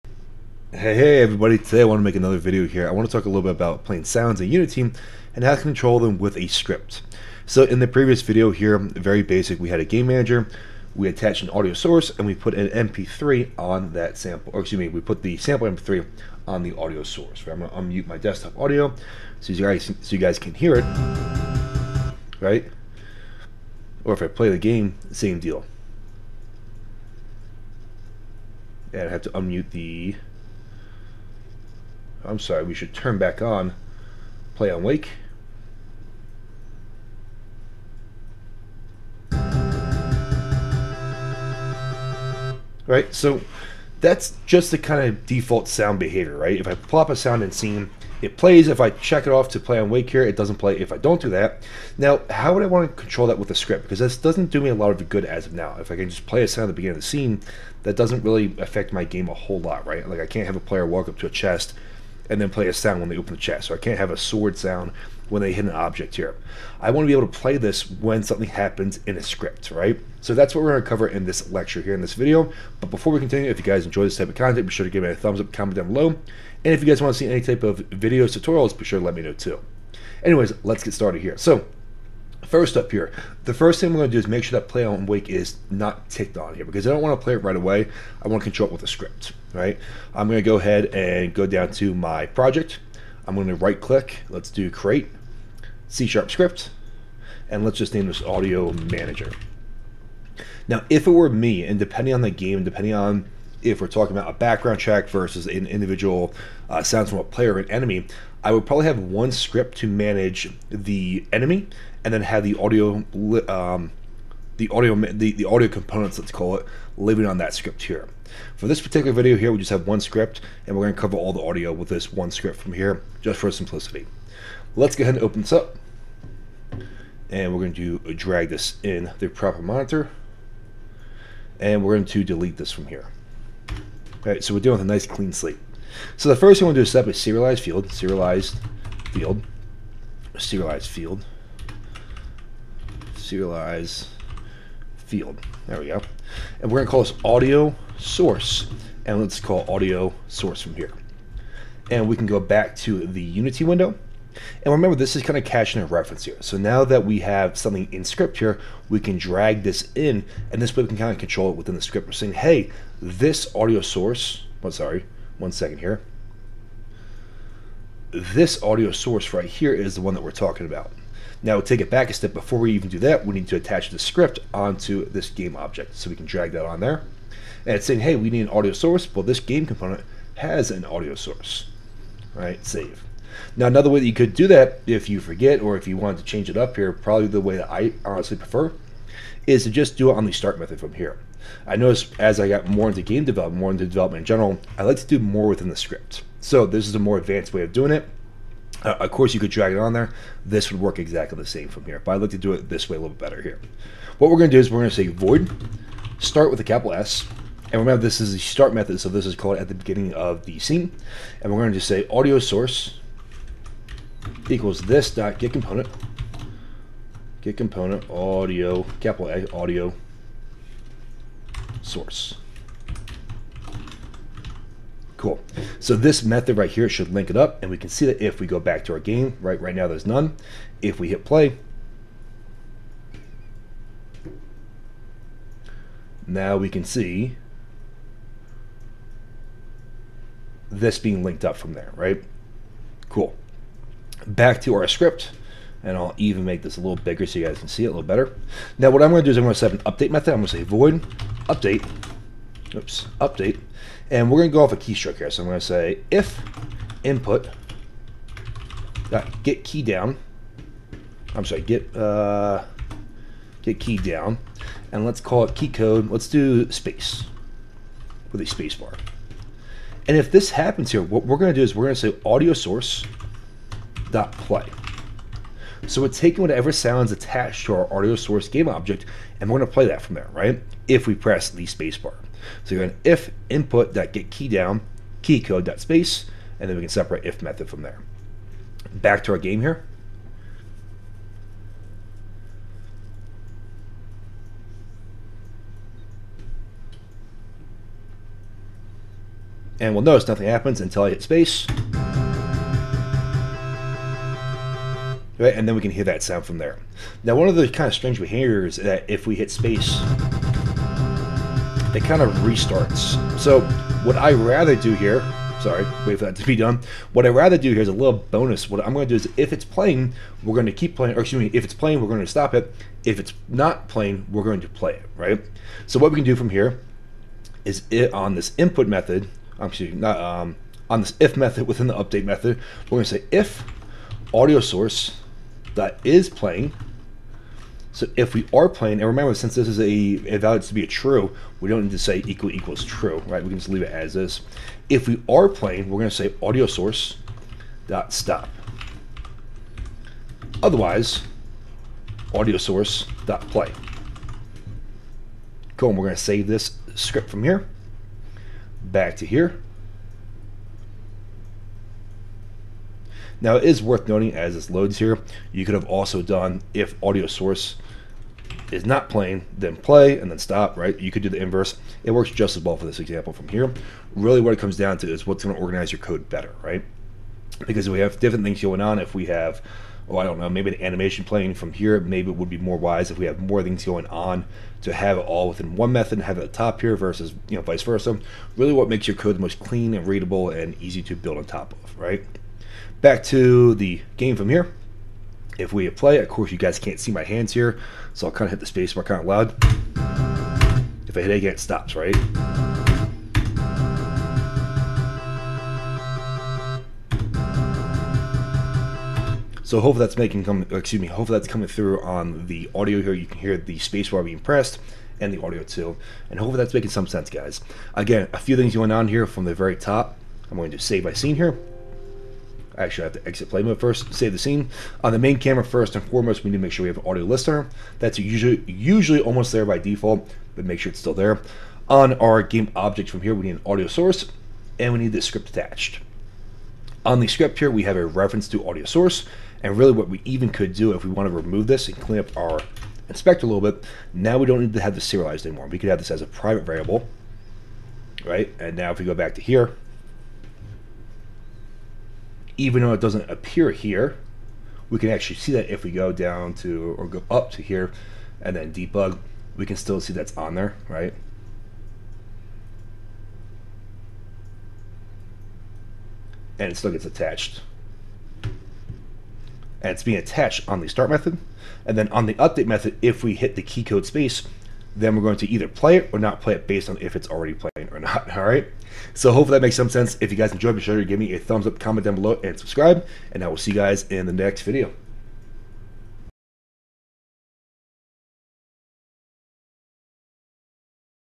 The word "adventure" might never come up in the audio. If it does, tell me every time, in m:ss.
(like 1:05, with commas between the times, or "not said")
not said.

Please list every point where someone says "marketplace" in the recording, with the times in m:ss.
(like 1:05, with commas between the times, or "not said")
not said.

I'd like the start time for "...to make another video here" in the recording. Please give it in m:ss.
0:01.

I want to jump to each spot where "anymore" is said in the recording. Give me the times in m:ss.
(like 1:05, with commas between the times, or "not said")
7:25.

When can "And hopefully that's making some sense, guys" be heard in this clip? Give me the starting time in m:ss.
6:56.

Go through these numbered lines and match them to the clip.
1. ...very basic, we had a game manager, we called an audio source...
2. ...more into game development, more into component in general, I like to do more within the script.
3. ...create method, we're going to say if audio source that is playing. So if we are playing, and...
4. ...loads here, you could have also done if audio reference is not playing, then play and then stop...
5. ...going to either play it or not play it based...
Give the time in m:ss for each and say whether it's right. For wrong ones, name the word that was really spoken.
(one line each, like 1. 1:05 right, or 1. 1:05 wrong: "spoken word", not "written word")
1. 0:08 wrong: "attached", not "called"
2. 3:12 wrong: "development", not "component"
3. 5:31 wrong: "update", not "create"
4. 6:04 wrong: "source", not "reference"
5. 7:55 right.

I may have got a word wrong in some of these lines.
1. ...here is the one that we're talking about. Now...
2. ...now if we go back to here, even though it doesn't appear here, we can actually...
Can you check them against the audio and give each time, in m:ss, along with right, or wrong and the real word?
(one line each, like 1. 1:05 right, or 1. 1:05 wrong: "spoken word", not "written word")
1. 2:49 right
2. 7:28 right.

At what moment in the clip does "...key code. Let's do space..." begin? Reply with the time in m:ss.
4:25.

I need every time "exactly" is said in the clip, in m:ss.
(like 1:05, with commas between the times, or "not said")
3:20.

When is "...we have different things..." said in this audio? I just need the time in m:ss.
6:17.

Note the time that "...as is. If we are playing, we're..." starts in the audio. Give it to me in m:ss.
5:43.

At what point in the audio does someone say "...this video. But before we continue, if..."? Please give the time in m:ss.
1:12.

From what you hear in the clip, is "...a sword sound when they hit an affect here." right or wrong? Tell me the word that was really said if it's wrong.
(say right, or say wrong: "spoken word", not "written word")
wrong: "object", not "affect".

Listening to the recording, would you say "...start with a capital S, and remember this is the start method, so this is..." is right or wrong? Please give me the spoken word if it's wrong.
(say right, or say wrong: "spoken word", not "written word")
right.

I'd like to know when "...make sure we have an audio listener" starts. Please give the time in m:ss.
7:06.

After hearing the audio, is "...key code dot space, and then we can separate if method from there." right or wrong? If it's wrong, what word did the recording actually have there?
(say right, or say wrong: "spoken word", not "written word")
right.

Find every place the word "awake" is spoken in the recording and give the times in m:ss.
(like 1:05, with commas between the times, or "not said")
0:34, 0:49, 1:25.